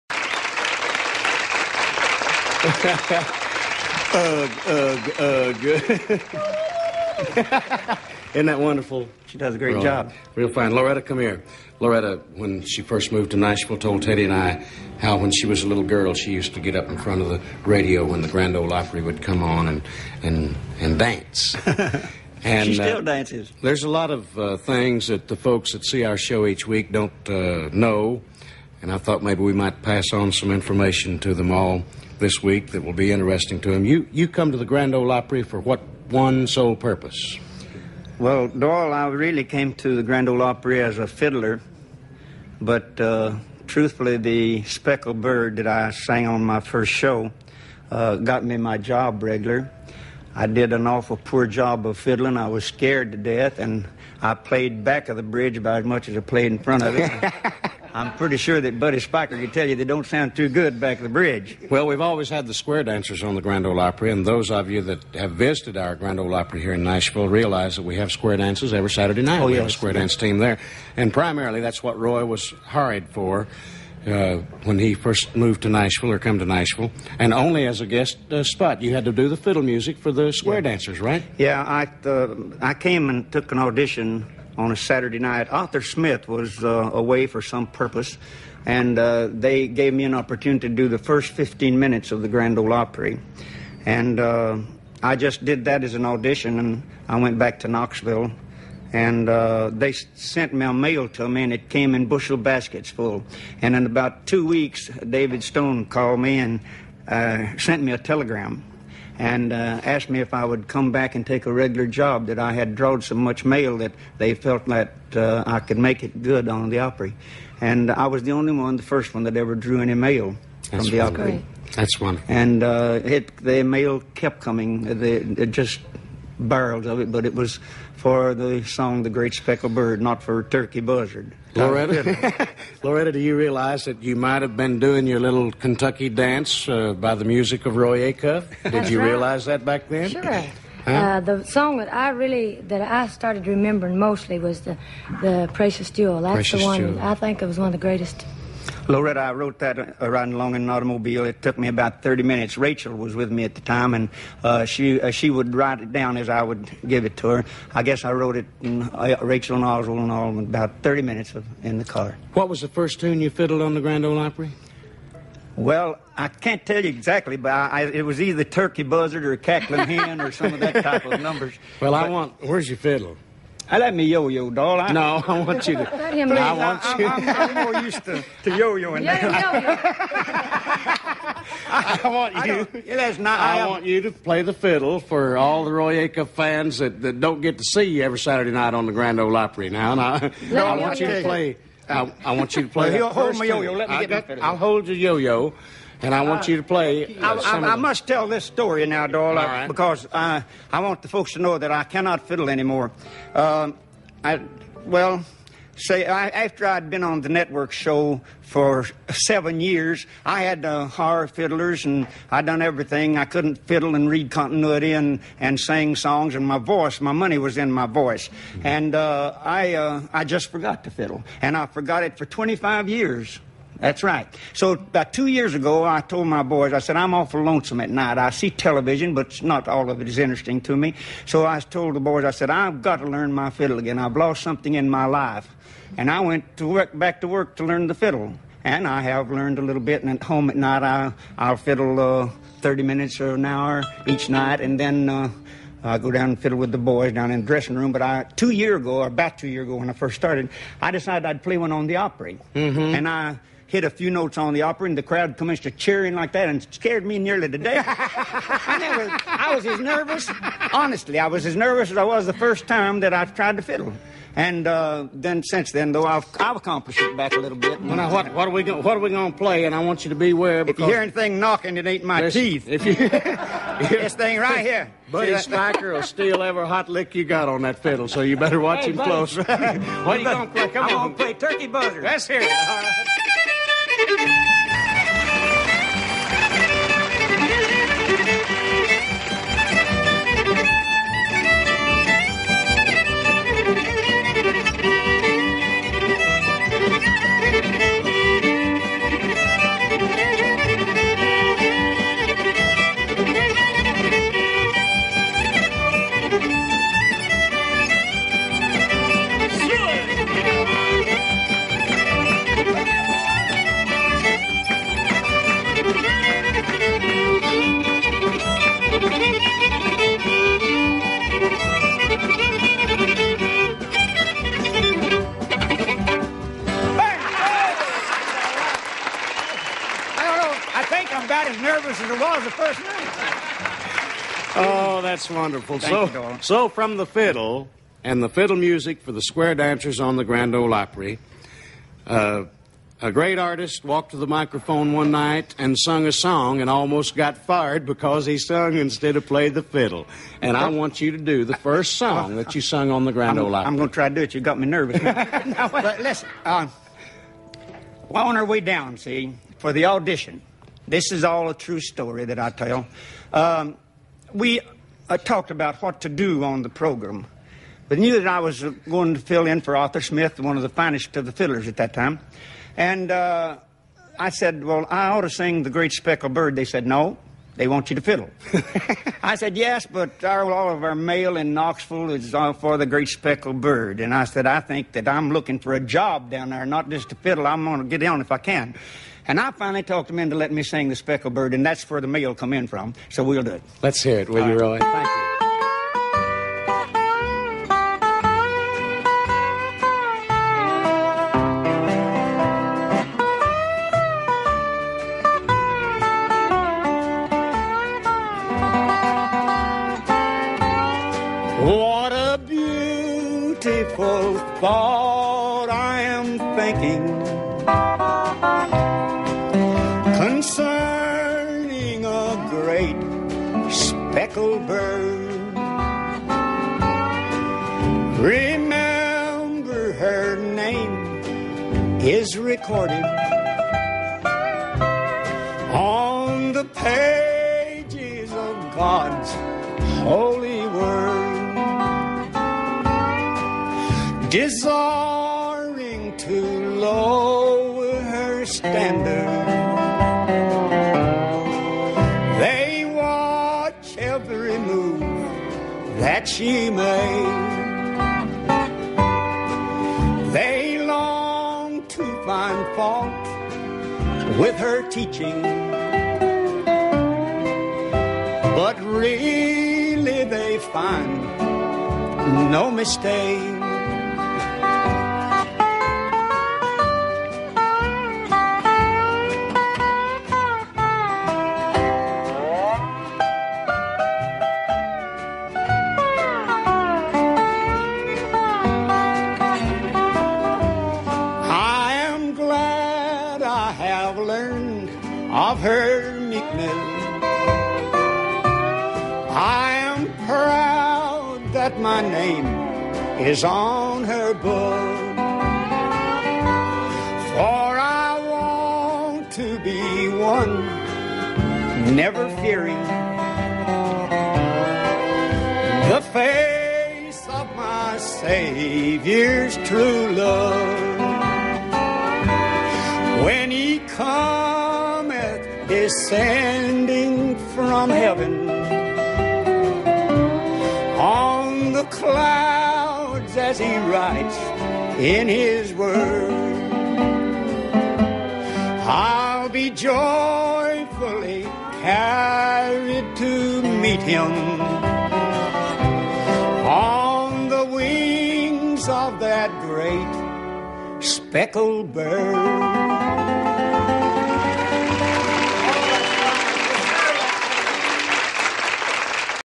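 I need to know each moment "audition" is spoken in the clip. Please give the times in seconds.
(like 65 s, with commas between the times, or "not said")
83 s, 96 s, 359 s.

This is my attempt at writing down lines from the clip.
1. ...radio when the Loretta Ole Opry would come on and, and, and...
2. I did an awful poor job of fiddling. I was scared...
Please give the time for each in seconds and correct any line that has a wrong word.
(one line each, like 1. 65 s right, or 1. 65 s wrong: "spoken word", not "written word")
1. 17 s wrong: "Grand", not "Loretta"
2. 50 s right.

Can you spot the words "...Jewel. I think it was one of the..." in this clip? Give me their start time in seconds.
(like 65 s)
146 s.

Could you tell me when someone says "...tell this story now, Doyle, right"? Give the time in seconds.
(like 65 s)
198 s.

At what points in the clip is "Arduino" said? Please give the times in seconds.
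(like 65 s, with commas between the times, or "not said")
not said.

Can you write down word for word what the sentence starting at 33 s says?
You, you come to the Grand Ole Opry for what one sole purpose?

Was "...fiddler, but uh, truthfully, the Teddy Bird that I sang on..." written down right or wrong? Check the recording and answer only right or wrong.
wrong.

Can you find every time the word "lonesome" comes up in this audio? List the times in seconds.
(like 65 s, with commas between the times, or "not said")
227 s.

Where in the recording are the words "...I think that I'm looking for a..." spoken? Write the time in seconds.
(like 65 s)
384 s.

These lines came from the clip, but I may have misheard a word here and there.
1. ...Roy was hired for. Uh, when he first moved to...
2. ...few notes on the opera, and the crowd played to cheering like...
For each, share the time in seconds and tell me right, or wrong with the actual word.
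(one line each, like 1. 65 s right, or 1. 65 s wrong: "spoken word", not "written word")
1. 71 s right
2. 253 s wrong: "commenced", not "played".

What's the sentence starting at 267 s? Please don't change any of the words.
Well, now, what, what are we what are we going to play?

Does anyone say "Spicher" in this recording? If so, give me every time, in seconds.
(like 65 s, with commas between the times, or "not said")
58 s, 275 s.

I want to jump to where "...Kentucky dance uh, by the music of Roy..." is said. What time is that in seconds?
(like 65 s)
135 s.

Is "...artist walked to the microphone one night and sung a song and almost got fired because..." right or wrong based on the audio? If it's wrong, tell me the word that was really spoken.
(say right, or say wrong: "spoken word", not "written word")
right.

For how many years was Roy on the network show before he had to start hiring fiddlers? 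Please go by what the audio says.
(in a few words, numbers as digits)
7.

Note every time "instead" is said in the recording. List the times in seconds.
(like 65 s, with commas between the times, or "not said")
348 s.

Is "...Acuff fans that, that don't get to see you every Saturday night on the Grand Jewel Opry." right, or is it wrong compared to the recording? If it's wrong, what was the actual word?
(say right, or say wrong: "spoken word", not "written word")
wrong: "Ole", not "Jewel".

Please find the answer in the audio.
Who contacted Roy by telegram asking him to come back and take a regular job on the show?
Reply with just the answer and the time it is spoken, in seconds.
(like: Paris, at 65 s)
David Stone, at 104 s.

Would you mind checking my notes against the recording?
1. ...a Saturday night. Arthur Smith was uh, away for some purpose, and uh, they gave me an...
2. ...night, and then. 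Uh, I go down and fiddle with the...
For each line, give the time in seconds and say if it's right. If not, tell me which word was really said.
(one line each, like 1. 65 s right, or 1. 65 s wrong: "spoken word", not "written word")
1. 84 s right
2. 244 s right.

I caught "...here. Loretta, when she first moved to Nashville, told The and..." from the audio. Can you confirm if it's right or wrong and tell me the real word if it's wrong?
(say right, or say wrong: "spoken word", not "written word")
wrong: "Teddy", not "The".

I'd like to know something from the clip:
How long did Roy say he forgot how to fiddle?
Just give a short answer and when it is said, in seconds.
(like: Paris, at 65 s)
25 years, at 222 s.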